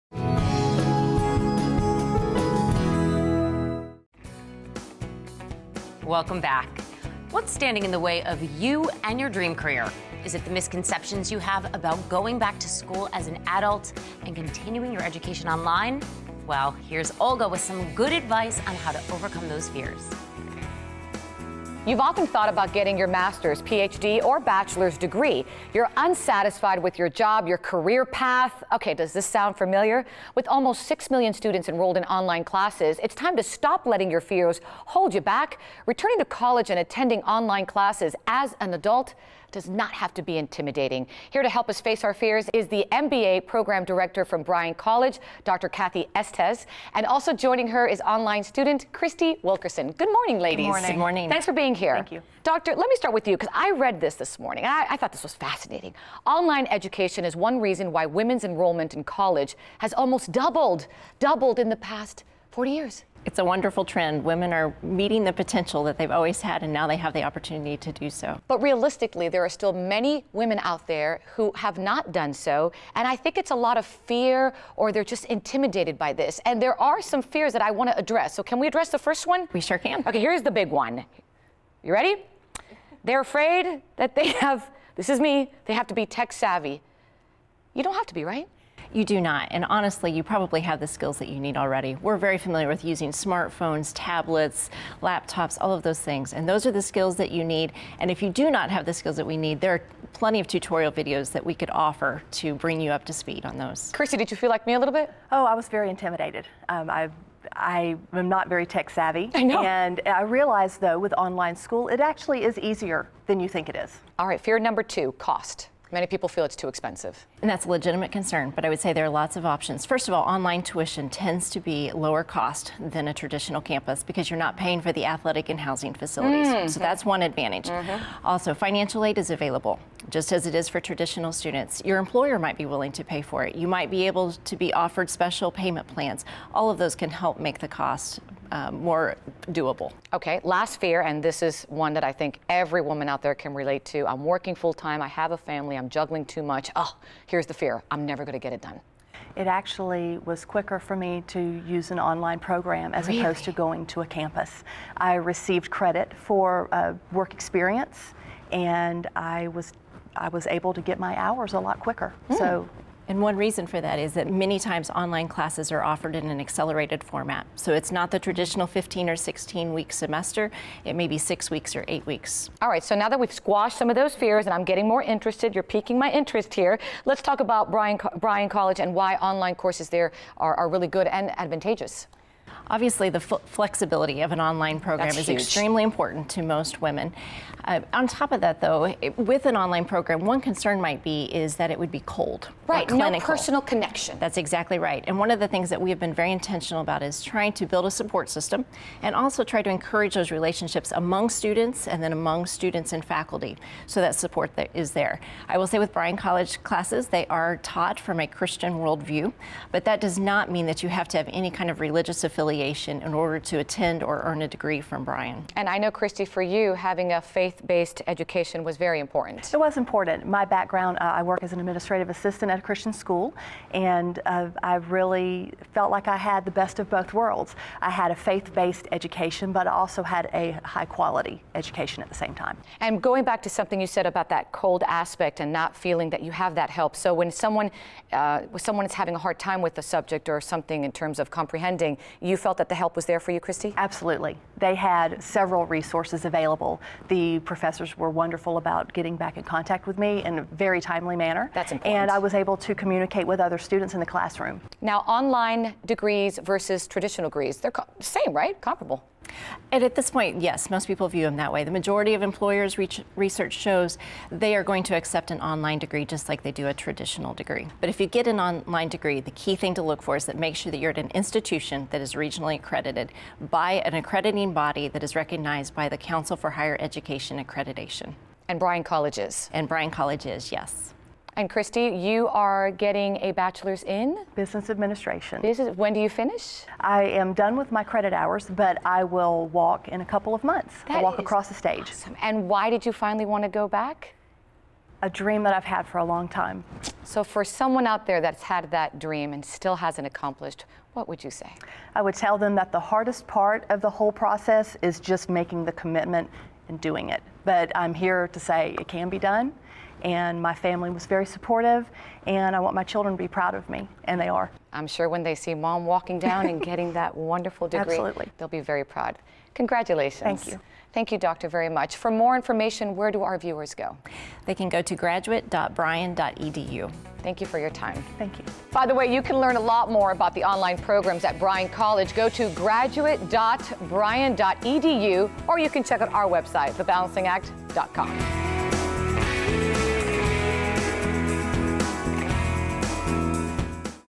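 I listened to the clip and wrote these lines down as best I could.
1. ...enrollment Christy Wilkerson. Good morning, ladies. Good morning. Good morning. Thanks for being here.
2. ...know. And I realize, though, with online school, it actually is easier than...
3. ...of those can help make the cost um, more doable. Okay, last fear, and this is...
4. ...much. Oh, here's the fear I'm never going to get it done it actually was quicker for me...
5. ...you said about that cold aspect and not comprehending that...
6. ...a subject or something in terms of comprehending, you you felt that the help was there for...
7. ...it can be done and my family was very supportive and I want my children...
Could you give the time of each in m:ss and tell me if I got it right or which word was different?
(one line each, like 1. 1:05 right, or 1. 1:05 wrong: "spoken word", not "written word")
1. 0:48 wrong: "student", not "enrollment"
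2. 1:49 right
3. 2:16 right
4. 2:26 right
5. 3:53 wrong: "feeling", not "comprehending"
6. 3:59 right
7. 5:08 right.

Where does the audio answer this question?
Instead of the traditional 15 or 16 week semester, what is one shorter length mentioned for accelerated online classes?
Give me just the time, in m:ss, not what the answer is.
2:51.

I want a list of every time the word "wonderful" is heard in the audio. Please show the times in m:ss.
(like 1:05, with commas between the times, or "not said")
1:03, 4:08, 5:17.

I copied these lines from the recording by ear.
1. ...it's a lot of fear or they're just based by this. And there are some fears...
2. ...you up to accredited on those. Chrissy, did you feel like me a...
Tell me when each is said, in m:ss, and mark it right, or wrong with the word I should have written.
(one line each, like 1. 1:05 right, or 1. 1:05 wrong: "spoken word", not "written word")
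1. 1:13 wrong: "intimidated", not "based"
2. 1:42 wrong: "speed", not "accredited".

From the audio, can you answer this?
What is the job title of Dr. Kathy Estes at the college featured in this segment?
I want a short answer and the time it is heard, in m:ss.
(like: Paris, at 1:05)
MBA program director, at 0:42.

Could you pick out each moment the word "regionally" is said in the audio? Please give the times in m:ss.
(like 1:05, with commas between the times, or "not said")
4:32.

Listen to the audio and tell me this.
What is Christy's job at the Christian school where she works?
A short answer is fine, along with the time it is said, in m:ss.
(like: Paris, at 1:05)
administrative assistant, at 3:41.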